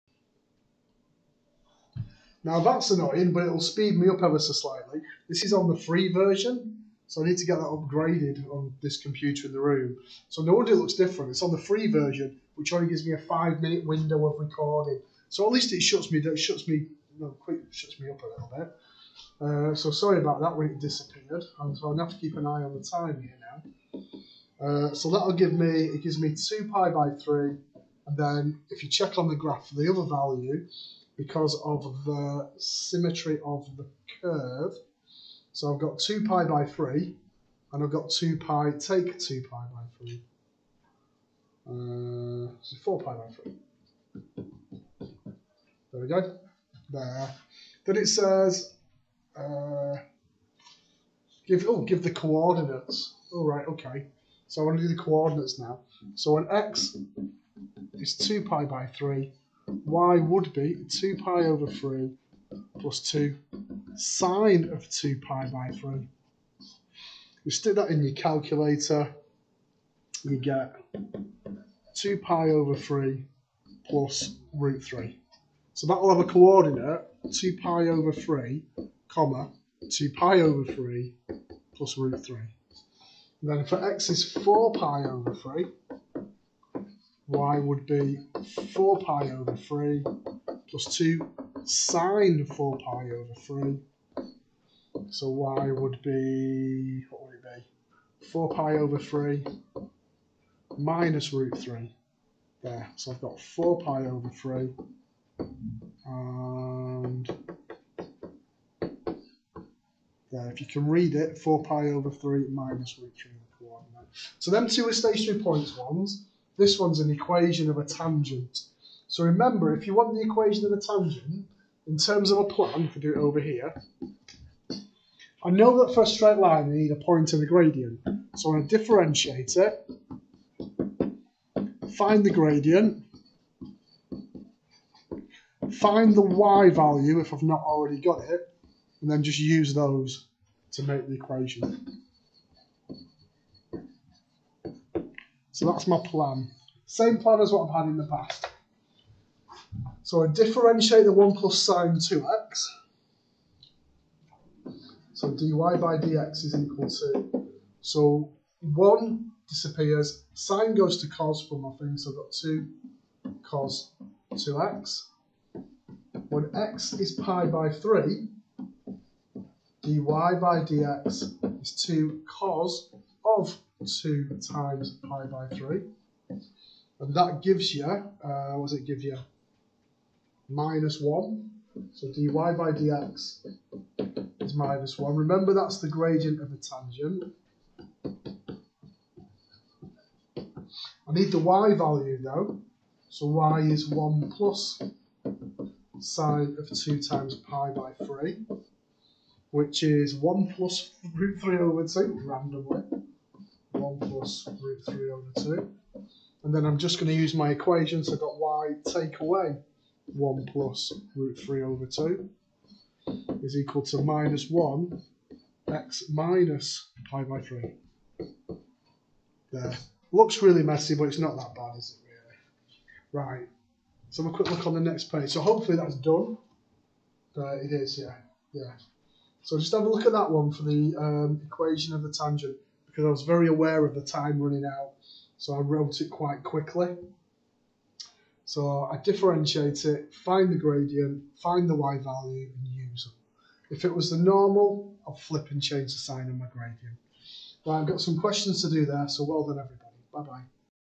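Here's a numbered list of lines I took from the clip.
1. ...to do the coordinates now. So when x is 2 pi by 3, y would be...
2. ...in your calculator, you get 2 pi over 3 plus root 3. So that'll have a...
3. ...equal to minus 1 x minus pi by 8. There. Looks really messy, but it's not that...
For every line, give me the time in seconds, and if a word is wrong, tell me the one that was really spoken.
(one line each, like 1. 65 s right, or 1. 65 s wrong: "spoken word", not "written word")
1. 54 s right
2. 67 s right
3. 213 s wrong: "3", not "8".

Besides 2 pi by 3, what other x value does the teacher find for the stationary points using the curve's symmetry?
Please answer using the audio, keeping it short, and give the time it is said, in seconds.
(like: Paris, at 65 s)
4 pi by 3, at 42 s.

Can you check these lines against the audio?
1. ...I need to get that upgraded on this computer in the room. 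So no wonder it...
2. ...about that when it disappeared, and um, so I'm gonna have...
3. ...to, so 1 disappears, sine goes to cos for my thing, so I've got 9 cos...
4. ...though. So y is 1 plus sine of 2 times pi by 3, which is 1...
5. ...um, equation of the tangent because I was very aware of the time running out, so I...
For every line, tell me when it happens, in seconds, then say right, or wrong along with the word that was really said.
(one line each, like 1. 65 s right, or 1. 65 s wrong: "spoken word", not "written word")
1. 7 s right
2. 20 s right
3. 156 s wrong: "2", not "9"
4. 192 s right
5. 230 s right.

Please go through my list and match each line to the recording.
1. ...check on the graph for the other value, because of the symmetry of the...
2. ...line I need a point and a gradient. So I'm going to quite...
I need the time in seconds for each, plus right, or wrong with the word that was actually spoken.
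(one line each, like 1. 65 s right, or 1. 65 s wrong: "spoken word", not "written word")
1. 28 s right
2. 126 s wrong: "differentiate", not "quite".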